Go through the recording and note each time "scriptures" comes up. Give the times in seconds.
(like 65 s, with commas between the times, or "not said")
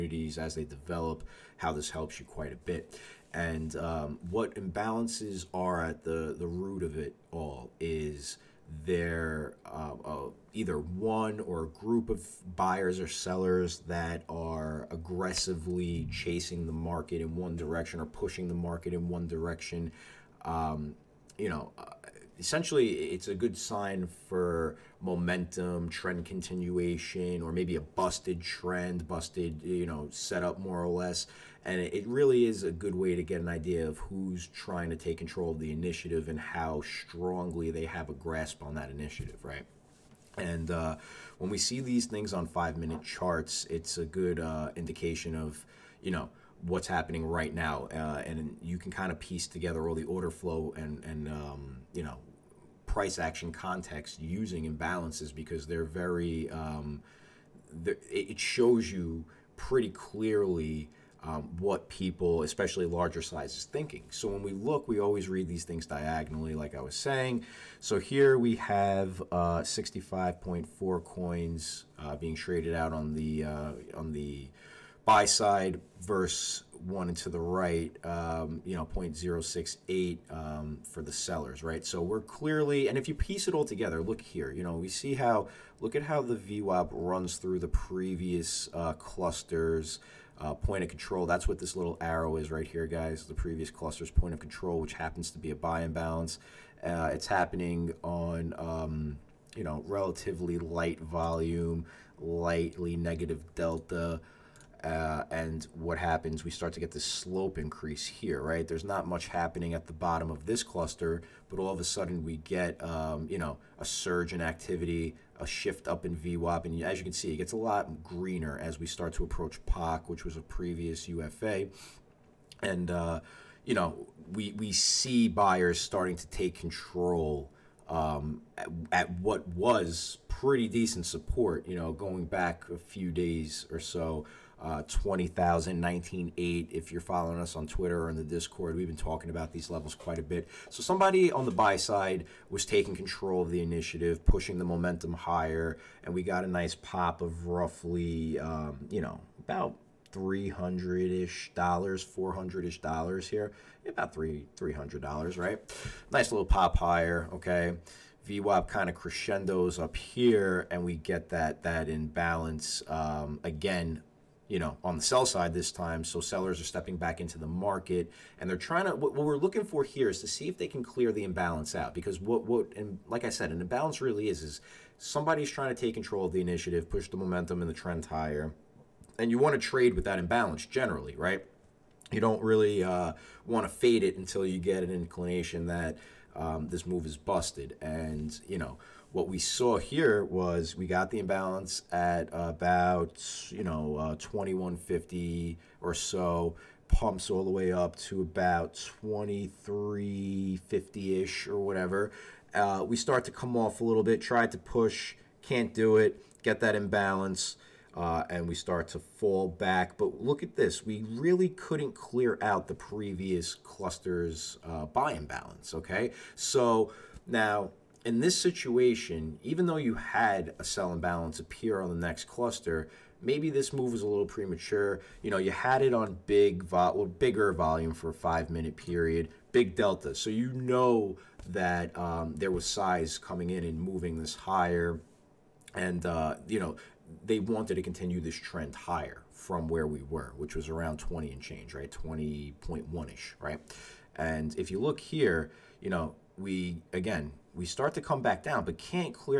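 not said.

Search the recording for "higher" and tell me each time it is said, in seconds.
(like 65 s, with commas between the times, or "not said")
145 s, 156 s, 178 s, 234 s, 238 s.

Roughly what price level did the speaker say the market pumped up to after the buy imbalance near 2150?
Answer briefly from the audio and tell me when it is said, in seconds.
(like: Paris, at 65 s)
2350, at 199 s.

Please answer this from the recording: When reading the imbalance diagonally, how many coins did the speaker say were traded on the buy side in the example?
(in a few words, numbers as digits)
65.4.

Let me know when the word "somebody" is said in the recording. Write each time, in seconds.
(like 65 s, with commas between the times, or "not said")
140 s, 174 s.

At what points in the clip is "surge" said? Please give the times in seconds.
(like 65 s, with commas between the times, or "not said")
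113 s.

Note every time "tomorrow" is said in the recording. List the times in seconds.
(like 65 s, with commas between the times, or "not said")
not said.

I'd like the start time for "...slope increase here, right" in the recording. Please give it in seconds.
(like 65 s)
107 s.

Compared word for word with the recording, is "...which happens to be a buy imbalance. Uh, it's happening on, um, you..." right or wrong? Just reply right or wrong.
right.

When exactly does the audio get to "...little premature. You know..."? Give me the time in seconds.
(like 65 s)
224 s.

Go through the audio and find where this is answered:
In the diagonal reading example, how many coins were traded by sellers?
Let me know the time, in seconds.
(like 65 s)
78 s.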